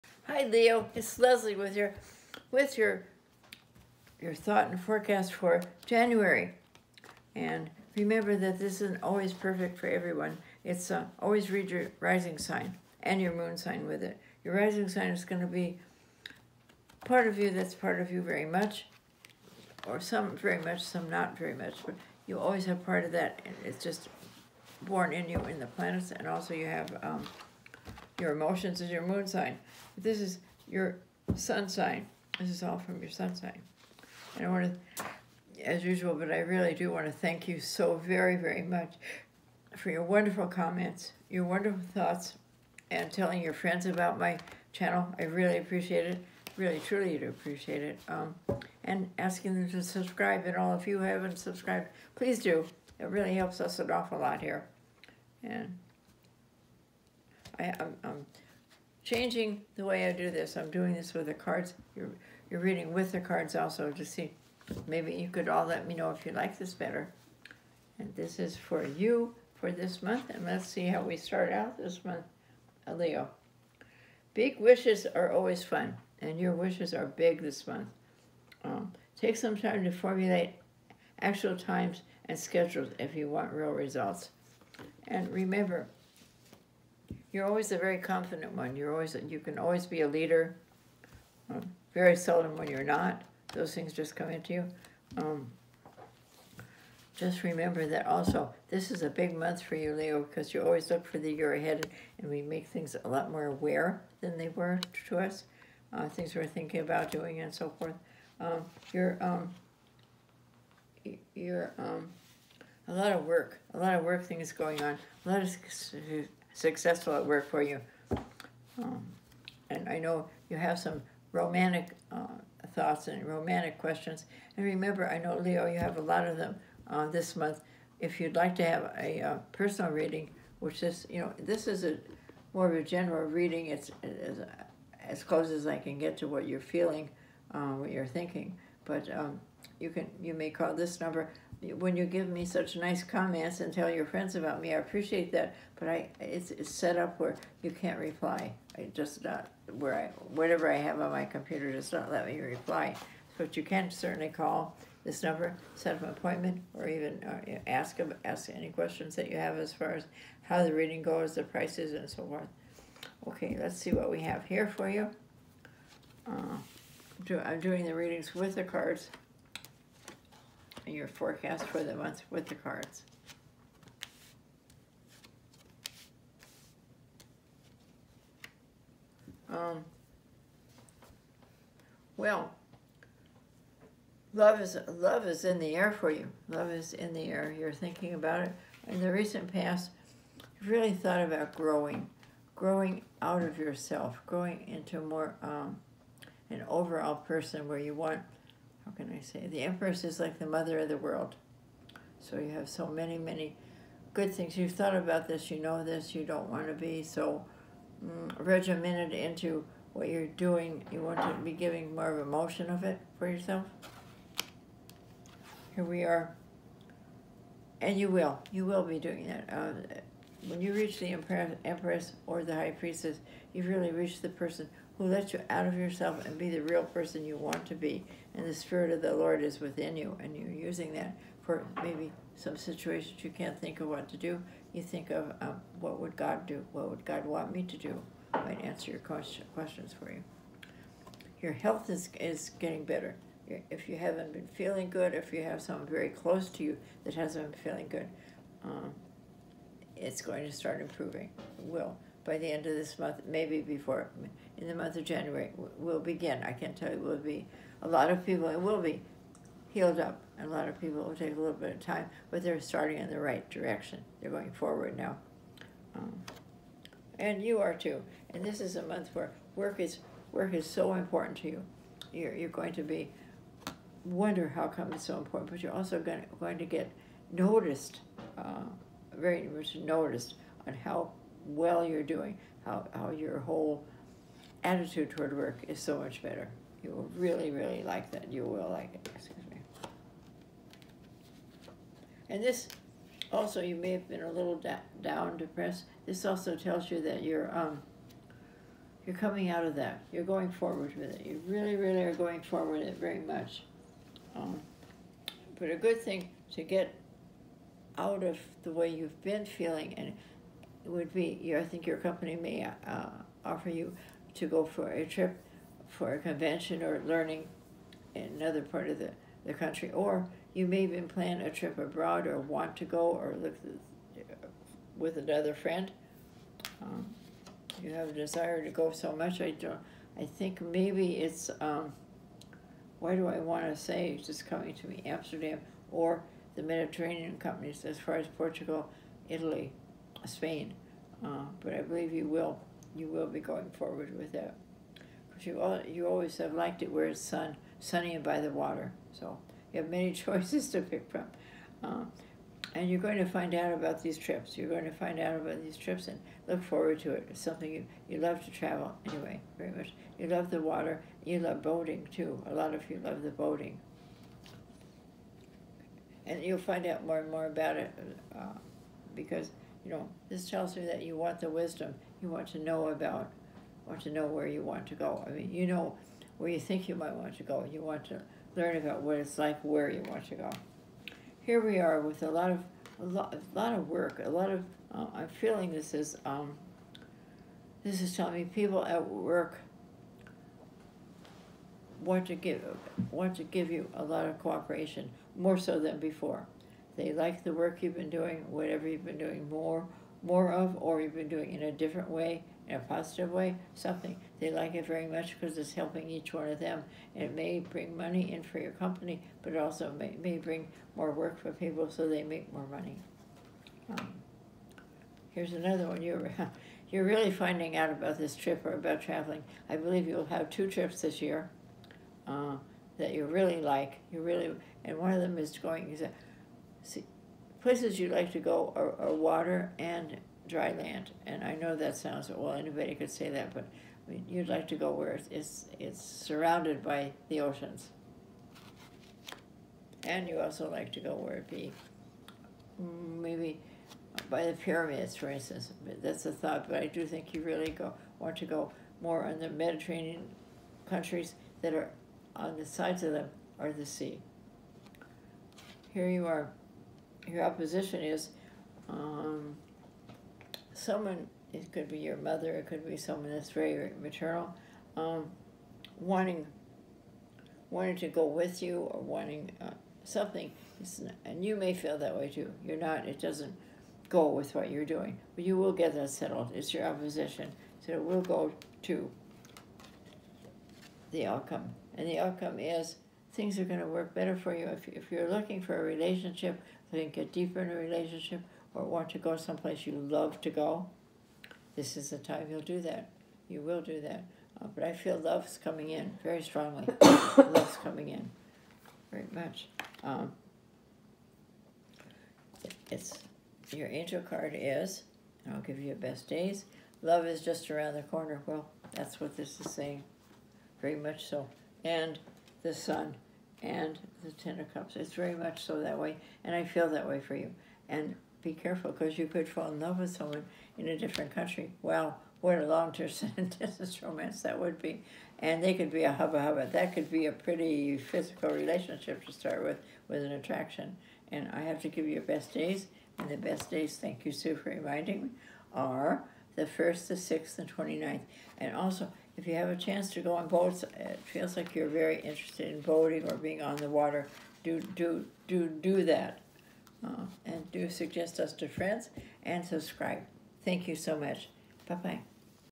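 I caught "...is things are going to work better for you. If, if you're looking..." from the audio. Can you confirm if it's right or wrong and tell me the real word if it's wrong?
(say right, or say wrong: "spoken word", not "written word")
right.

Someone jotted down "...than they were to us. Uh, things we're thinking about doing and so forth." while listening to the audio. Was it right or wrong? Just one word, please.
right.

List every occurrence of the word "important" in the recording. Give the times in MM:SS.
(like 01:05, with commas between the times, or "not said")
04:30, 04:35.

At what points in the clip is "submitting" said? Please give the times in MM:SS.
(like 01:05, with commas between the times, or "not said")
not said.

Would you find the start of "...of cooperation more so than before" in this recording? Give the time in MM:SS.
06:34.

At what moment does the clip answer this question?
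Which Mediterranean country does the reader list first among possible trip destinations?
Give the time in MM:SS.
05:38.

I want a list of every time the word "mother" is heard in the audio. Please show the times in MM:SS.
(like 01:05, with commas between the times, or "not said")
03:20, 07:42.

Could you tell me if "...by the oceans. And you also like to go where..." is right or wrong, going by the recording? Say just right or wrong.
right.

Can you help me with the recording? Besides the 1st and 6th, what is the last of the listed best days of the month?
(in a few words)
29th.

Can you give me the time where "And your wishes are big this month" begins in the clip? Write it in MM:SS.
01:16.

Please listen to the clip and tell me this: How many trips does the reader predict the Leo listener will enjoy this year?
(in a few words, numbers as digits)
2.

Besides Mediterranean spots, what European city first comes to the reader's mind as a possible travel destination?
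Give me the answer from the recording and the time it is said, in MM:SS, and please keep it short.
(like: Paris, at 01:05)
Amsterdam, at 05:35.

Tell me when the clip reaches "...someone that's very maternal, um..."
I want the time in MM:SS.
07:42.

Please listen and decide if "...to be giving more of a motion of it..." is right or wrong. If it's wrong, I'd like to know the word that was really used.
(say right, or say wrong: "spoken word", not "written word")
right.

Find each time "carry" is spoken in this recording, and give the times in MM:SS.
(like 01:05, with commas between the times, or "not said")
not said.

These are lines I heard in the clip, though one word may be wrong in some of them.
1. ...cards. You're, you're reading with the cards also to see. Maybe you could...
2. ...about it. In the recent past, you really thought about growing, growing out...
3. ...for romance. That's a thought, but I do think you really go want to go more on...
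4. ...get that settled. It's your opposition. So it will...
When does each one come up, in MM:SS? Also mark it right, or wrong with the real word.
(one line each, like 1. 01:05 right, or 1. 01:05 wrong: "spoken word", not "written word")
1. 01:01 right
2. 03:08 right
3. 07:25 wrong: "instance", not "romance"
4. 07:55 right.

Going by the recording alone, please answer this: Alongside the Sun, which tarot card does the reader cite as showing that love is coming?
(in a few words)
Ten of Cups.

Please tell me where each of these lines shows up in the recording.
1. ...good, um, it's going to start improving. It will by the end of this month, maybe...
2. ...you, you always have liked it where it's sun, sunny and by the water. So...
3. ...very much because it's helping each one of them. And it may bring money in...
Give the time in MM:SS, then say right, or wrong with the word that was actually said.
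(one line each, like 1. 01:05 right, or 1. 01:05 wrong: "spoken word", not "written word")
1. 04:07 right
2. 05:45 right
3. 06:44 right.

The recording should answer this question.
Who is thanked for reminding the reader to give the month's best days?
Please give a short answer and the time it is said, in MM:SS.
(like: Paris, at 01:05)
Sue, at 08:54.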